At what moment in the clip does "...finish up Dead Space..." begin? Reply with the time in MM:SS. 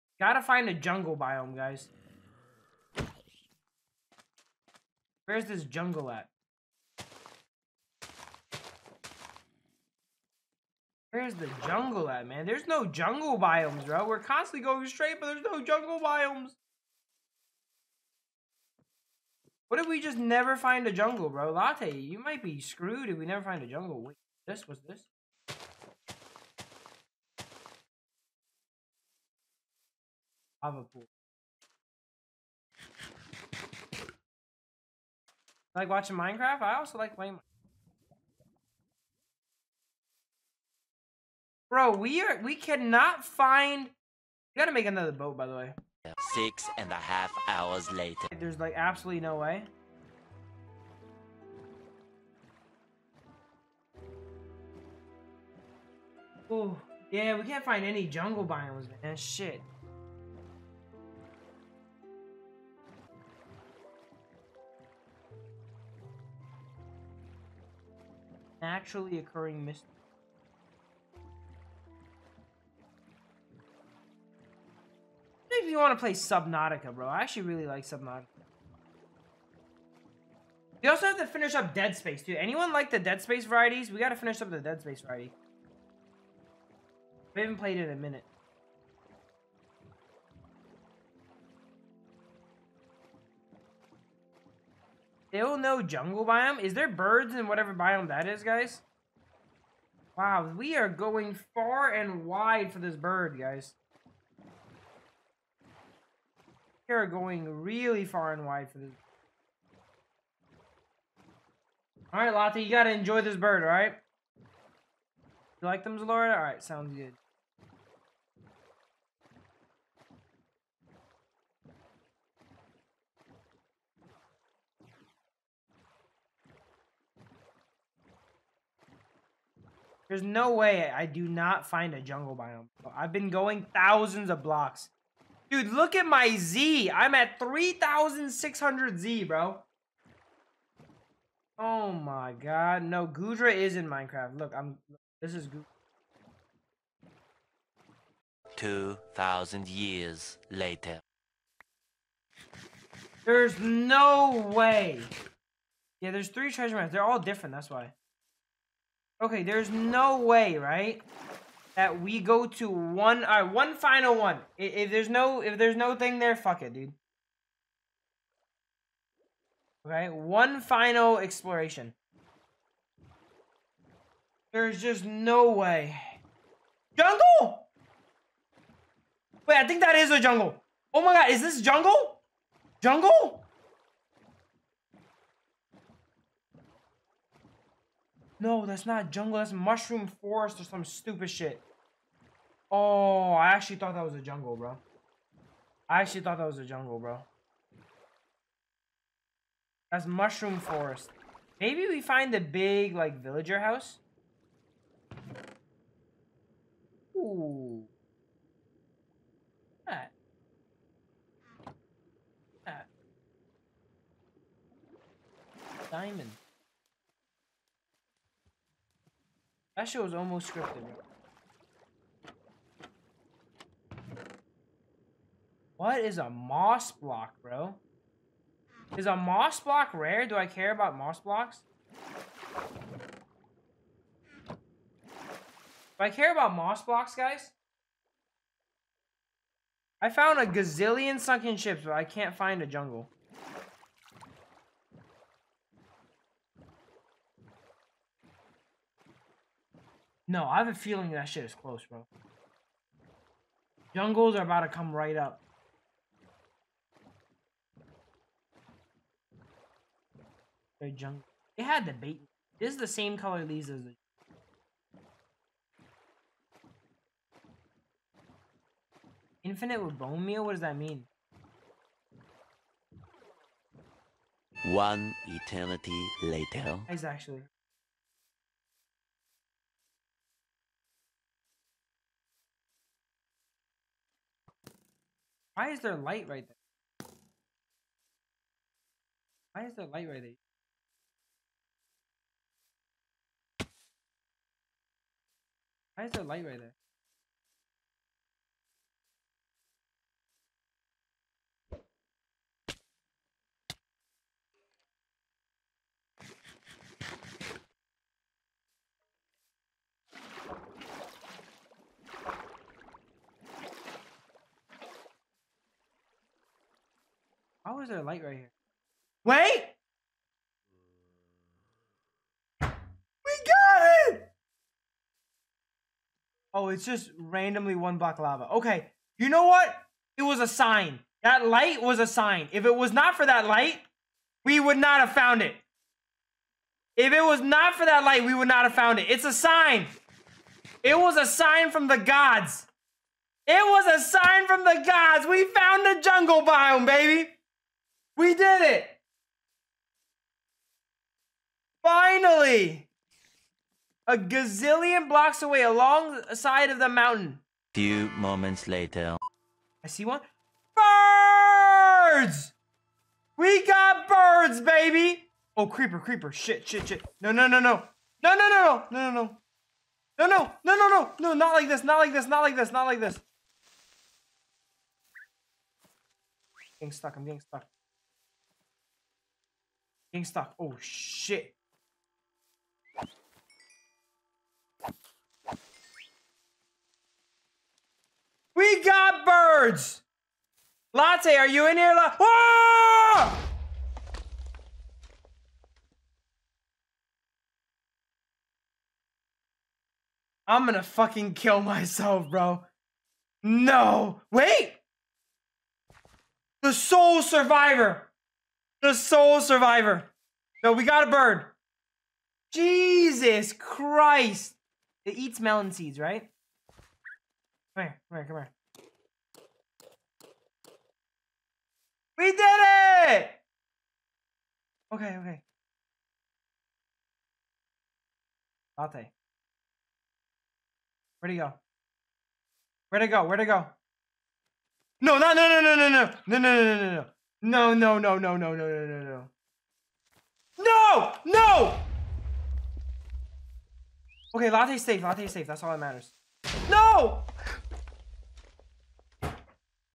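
01:21.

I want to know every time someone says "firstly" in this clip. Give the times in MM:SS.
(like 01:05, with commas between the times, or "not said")
not said.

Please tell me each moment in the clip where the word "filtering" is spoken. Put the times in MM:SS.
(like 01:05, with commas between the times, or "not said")
not said.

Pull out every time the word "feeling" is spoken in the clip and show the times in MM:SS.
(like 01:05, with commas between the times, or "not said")
04:10.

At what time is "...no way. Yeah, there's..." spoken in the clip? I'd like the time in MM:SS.
02:33.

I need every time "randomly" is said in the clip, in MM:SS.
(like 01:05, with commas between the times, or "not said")
05:27.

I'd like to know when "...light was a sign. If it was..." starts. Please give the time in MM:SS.
05:31.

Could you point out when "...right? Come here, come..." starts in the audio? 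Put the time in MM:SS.
06:55.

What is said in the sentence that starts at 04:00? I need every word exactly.
I found a gazillion sunken ships, but I can't find a jungle.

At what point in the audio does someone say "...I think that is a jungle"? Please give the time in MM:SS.
02:59.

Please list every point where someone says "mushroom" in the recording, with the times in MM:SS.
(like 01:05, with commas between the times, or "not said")
03:09, 03:20.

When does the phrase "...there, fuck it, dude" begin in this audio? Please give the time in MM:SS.
02:46.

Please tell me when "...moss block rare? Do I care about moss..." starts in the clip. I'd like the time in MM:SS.
03:49.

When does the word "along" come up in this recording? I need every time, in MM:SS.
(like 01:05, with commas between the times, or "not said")
05:55.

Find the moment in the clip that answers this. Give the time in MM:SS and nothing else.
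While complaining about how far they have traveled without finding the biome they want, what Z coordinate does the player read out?
02:17.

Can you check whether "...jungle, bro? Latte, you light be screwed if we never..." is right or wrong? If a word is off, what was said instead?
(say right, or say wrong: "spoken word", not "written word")
wrong: "might", not "light".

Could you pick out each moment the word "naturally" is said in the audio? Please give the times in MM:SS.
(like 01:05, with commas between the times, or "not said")
01:08.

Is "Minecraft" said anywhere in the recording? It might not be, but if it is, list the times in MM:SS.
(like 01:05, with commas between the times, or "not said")
00:36, 02:23.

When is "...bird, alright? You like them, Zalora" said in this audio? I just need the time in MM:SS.
01:53.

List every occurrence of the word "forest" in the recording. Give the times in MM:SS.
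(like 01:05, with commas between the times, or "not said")
03:10, 03:20.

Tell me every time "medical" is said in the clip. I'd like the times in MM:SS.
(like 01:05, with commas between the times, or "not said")
not said.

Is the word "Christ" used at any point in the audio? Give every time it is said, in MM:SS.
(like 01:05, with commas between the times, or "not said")
06:53.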